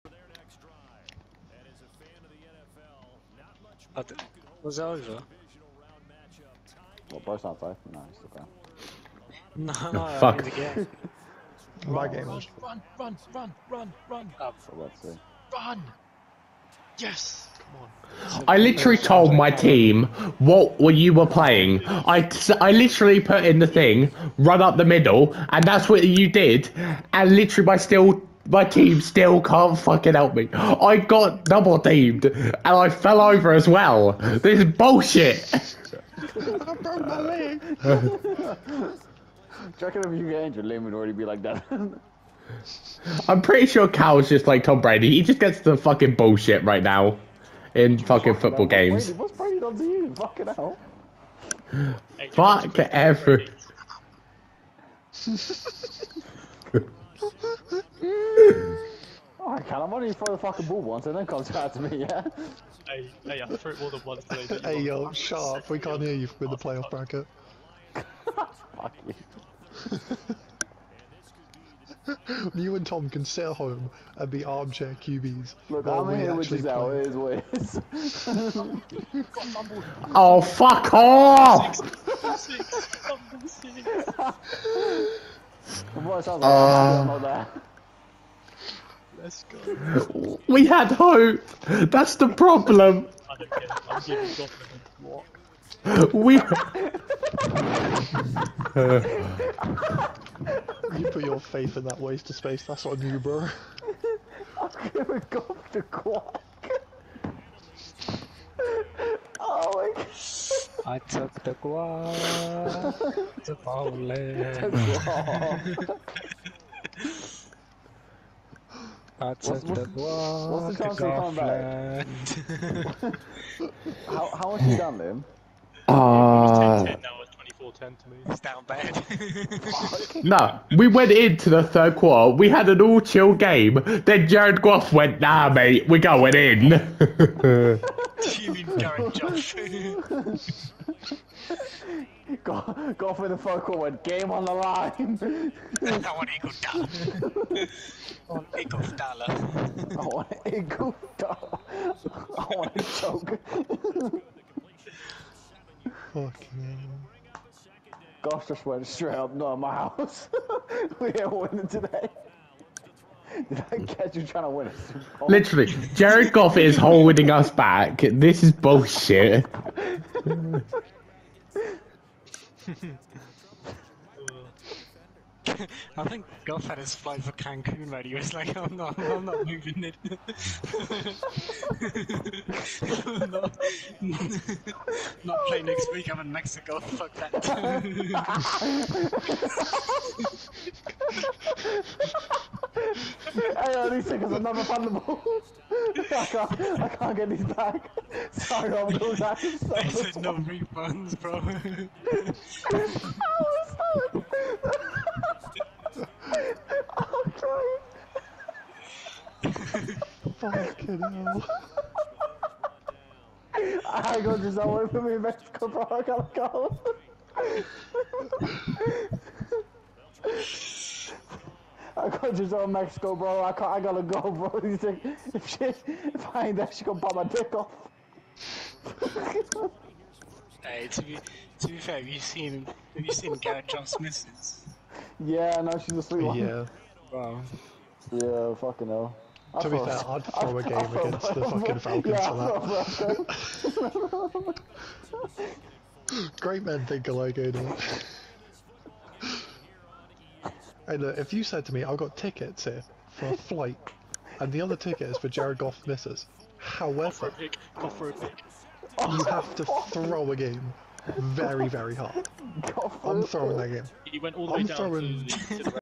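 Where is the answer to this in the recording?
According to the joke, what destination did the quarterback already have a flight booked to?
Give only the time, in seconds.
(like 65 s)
177 s.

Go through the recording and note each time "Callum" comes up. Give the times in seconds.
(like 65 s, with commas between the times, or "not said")
59 s.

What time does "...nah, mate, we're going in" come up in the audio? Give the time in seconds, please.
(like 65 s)
135 s.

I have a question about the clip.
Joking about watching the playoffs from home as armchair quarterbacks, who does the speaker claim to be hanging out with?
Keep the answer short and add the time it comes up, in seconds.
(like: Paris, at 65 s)
Gisele, at 76 s.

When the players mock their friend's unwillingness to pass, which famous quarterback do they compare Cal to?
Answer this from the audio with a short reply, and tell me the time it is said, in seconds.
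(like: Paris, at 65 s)
Tom Brady, at 44 s.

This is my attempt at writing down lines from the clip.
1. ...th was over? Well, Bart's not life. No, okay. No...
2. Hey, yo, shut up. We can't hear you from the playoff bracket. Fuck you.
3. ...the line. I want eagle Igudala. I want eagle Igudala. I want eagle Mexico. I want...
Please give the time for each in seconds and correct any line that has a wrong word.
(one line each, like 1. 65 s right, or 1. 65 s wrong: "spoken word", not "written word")
1. 4 s right
2. 64 s right
3. 144 s wrong: "Igudala", not "Mexico".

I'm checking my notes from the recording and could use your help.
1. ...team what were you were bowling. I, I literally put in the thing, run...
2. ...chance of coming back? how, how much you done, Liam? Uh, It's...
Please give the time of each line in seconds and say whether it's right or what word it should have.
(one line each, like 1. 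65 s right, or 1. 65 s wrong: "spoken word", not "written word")
1. 19 s wrong: "playing", not "bowling"
2. 120 s right.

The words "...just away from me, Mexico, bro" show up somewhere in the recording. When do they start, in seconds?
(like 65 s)
214 s.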